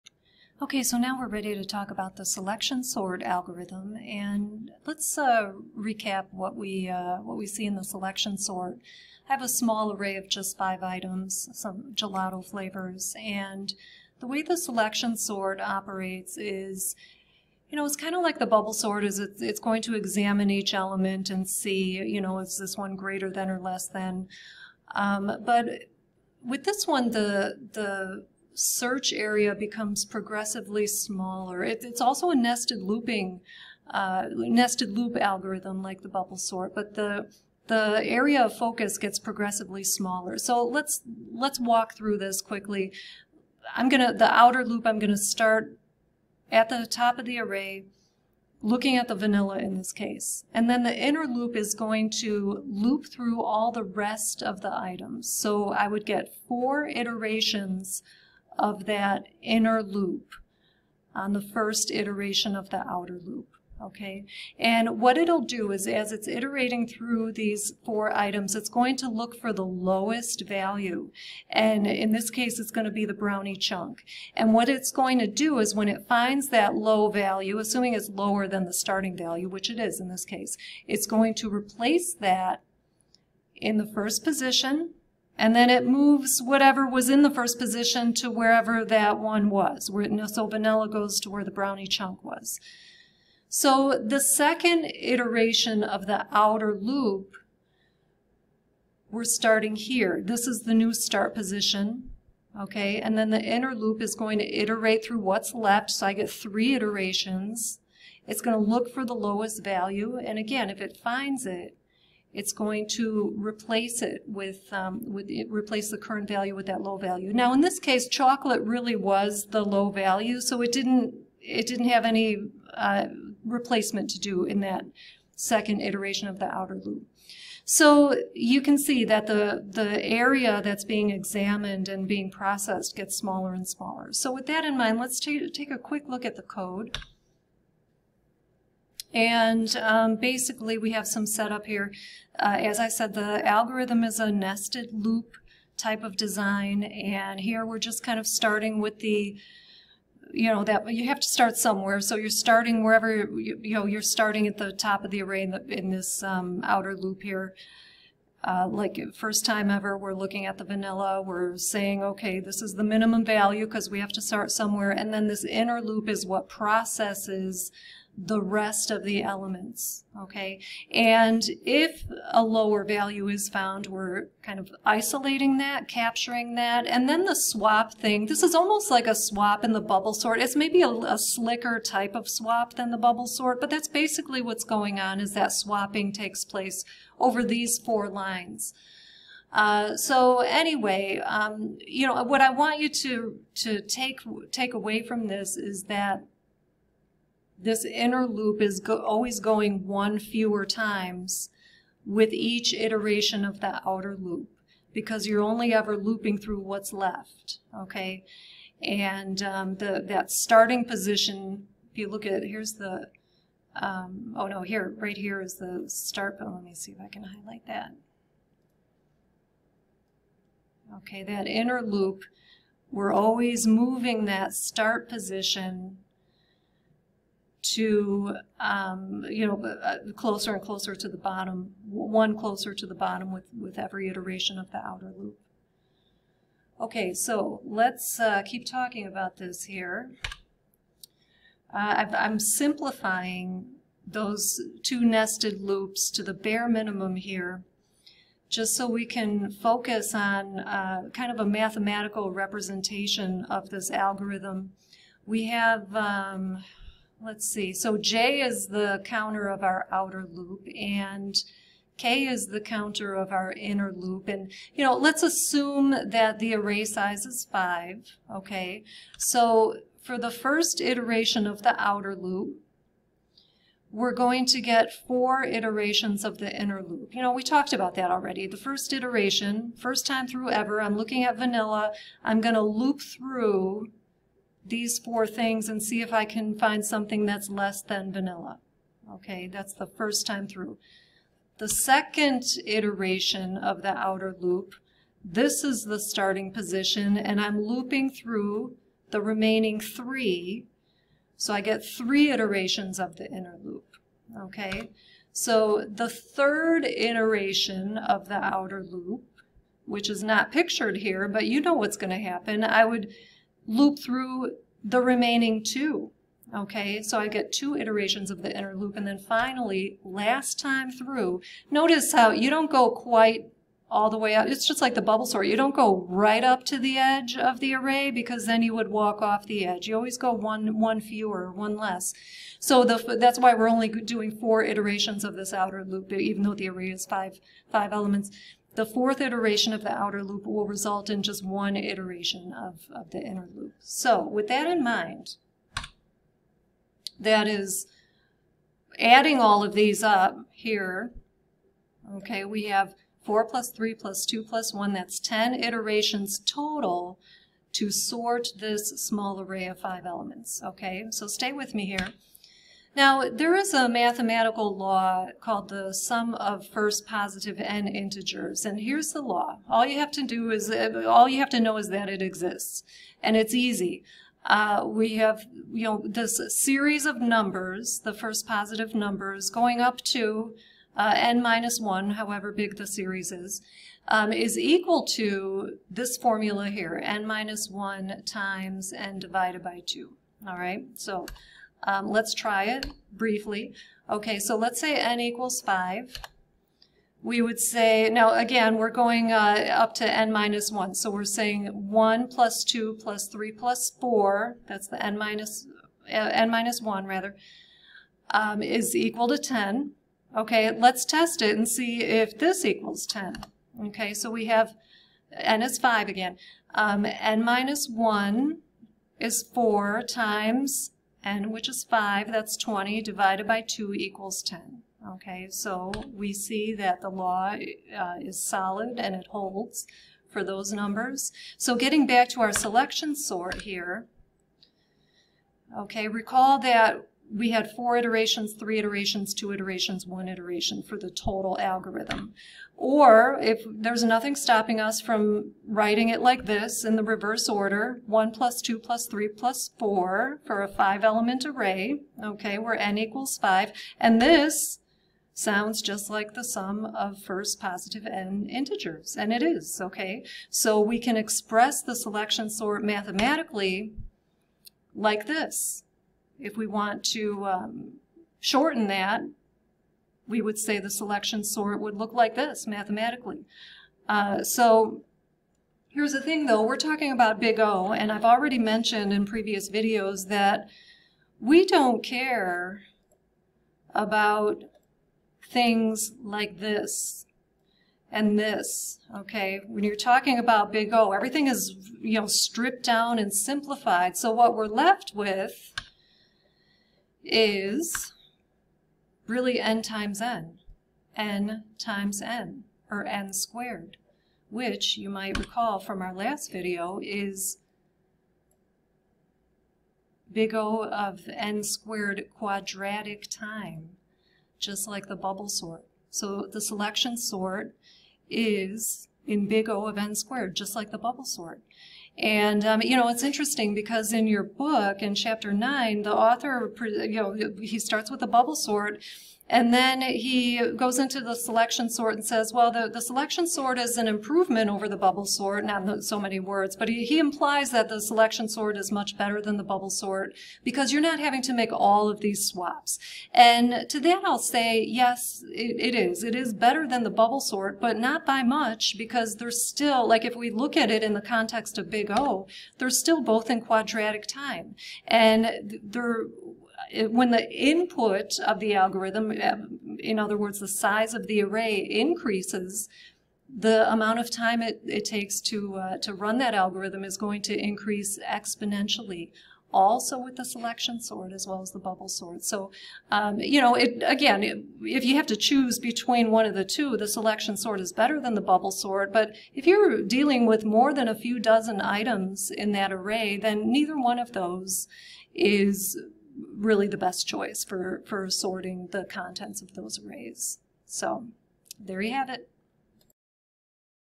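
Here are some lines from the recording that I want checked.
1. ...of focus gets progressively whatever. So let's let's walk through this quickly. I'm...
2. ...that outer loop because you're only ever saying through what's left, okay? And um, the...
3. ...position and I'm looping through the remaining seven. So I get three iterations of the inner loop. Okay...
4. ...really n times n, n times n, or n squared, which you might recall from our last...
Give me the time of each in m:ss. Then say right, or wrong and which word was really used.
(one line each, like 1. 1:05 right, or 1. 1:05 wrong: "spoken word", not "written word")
1. 0:38 wrong: "smaller", not "whatever"
2. 3:23 wrong: "looping", not "saying"
3. 4:56 wrong: "three", not "seven"
4. 8:19 right.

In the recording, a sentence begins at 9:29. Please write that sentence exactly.
Also with the selection sort as well as the bubble sort.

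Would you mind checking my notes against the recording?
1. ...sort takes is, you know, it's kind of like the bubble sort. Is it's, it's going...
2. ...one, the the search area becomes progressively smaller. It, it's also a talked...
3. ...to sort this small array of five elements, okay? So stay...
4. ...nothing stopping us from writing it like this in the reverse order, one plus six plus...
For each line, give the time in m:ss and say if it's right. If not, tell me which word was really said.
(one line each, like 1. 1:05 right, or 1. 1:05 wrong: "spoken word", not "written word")
1. 0:15 wrong: "operates", not "takes"
2. 0:26 wrong: "nested", not "talked"
3. 5:57 right
4. 7:24 wrong: "two", not "six".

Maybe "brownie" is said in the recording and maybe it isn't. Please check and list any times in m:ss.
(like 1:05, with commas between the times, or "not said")
1:13, 1:31.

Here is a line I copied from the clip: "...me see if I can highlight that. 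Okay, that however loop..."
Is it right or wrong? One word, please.
wrong.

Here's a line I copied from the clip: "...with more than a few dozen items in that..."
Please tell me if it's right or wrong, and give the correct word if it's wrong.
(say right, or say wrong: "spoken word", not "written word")
right.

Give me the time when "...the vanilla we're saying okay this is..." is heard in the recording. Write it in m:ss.
2:40.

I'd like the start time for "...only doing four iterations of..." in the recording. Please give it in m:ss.
5:33.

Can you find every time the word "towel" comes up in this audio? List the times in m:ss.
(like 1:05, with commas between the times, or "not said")
not said.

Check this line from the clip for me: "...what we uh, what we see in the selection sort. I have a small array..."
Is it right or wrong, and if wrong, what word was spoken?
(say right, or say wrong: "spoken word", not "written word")
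right.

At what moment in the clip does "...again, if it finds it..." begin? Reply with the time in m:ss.
1:50.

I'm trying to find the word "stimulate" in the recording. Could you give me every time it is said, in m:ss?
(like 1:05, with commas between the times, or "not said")
not said.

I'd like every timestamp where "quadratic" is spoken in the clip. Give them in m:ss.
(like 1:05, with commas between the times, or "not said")
8:32, 9:13.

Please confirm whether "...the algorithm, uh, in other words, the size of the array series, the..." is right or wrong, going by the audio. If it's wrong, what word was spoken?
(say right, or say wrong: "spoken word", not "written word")
wrong: "increases", not "series".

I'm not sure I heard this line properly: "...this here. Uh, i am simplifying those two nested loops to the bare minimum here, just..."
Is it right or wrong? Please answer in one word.
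right.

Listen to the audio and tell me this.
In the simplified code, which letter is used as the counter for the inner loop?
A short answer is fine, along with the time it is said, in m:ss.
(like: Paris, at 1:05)
K, at 4:21.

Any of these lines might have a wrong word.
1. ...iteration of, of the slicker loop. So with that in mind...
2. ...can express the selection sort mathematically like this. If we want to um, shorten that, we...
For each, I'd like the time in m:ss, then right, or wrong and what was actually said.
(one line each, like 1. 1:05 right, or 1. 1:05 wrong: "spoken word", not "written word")
1. 5:41 wrong: "inner", not "slicker"
2. 7:40 right.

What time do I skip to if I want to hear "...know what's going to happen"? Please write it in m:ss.
5:11.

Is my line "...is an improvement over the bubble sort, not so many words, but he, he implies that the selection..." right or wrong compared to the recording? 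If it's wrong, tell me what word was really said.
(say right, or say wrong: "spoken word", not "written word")
right.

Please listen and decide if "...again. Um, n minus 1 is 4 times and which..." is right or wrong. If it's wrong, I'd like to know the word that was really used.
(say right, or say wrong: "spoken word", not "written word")
right.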